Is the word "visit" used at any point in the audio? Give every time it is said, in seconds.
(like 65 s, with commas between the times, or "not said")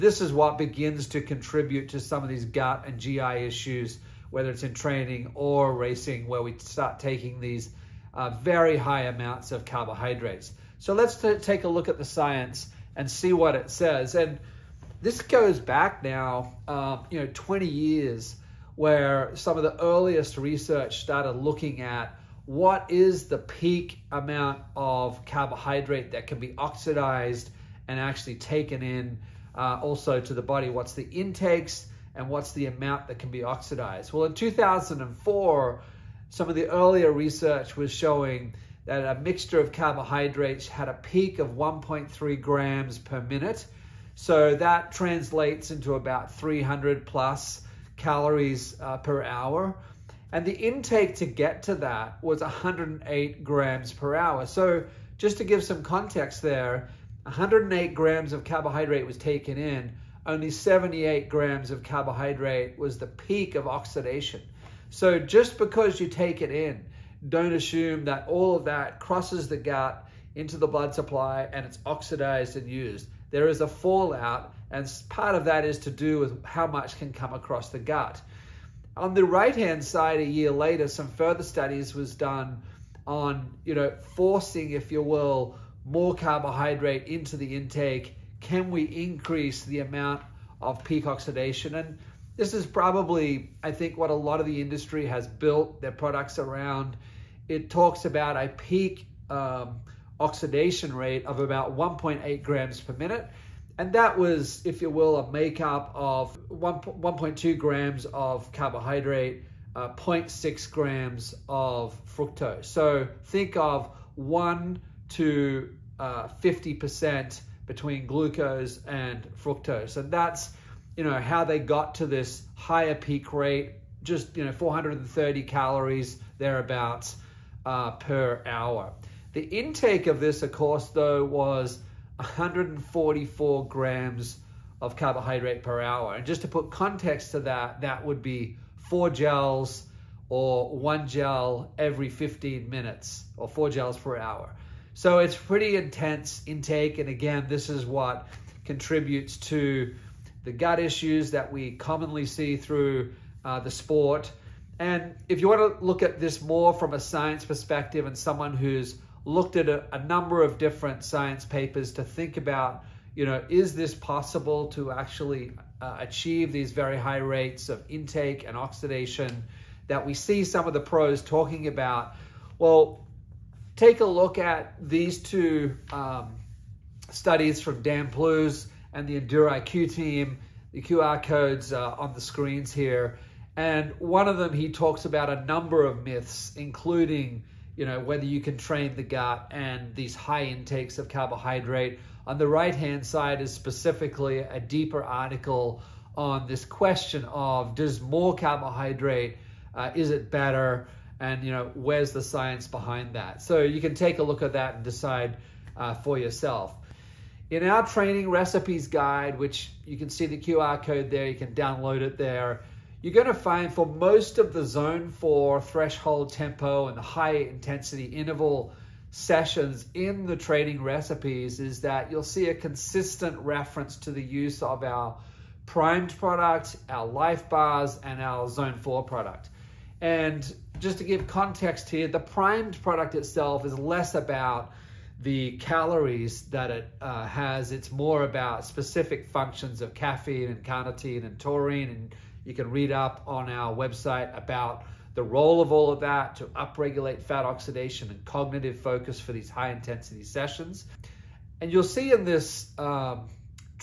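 not said.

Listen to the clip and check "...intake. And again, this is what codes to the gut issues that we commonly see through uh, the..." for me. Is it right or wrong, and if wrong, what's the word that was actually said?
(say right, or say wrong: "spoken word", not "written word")
wrong: "contributes", not "codes".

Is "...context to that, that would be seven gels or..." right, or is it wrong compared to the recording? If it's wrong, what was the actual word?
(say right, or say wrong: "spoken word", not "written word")
wrong: "four", not "seven".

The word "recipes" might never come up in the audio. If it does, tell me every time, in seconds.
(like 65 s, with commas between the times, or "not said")
208 s, 220 s.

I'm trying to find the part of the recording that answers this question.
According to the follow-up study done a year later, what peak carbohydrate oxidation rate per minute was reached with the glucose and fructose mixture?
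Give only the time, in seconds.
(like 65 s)
101 s.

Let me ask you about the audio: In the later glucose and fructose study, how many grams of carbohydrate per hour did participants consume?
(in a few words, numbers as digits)
144 grams.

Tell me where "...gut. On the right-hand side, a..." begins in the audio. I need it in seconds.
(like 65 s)
77 s.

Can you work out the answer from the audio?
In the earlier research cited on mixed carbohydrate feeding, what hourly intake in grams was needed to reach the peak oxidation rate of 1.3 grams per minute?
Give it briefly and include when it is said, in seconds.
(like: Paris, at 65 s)
108 grams per hour, at 52 s.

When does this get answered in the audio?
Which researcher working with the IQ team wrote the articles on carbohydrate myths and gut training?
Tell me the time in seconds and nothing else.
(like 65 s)
177 s.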